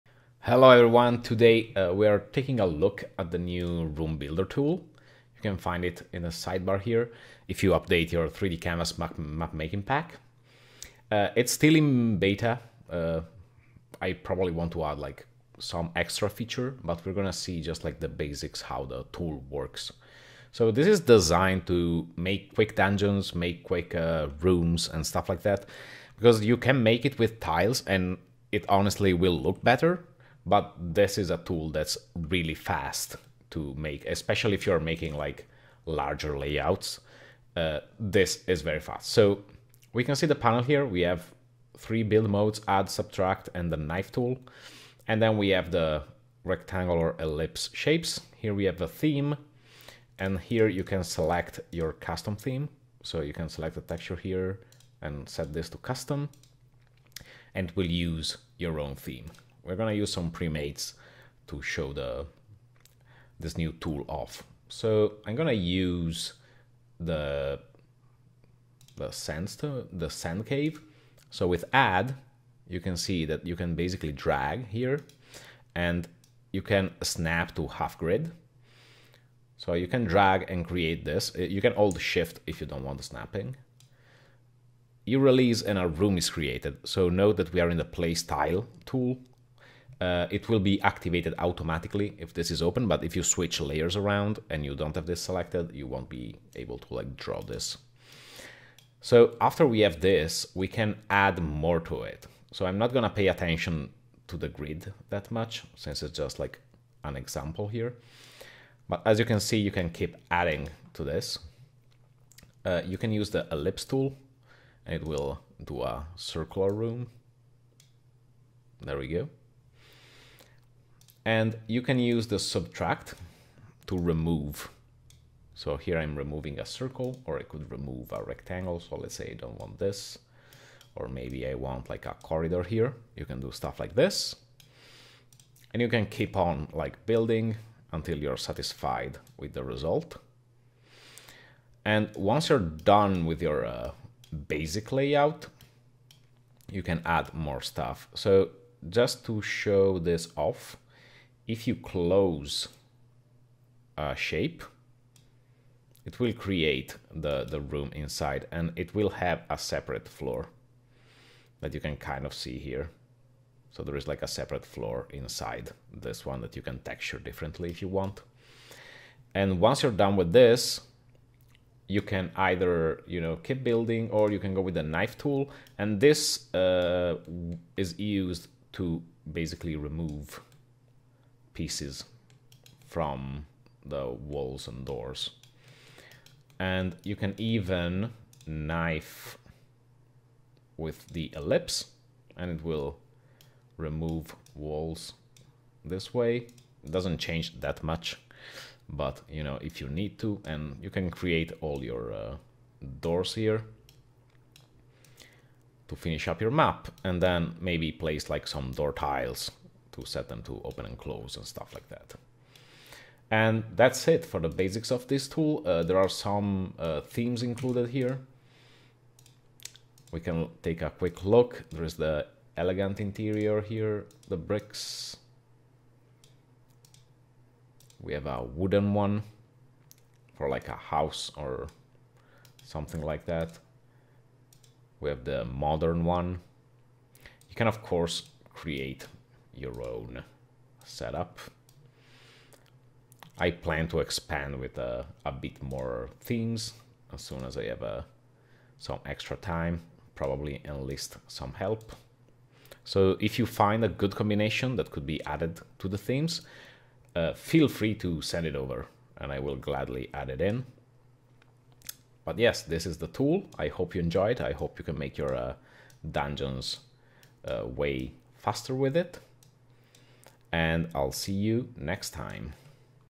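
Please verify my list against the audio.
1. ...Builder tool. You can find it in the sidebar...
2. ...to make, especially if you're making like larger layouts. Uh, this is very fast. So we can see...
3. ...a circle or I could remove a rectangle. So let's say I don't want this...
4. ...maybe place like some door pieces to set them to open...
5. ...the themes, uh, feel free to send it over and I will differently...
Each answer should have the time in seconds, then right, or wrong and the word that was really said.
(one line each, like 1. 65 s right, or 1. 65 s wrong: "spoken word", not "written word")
1. 4 s right
2. 33 s right
3. 126 s right
4. 207 s wrong: "tiles", not "pieces"
5. 255 s wrong: "gladly", not "differently".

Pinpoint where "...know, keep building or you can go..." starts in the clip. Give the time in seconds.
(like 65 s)
173 s.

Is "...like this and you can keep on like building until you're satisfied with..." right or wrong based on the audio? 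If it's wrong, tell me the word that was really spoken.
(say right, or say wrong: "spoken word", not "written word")
right.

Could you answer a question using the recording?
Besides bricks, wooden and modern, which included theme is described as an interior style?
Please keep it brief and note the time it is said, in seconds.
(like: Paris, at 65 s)
Elegant interior, at 222 s.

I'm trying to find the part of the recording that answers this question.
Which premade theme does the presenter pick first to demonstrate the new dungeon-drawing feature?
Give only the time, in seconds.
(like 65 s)
69 s.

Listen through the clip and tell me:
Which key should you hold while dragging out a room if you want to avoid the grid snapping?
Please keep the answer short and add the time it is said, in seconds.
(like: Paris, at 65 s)
Shift, at 82 s.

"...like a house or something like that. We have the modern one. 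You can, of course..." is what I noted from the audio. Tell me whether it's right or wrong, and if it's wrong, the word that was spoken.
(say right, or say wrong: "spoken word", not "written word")
right.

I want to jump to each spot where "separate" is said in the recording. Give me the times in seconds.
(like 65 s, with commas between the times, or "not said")
159 s, 164 s.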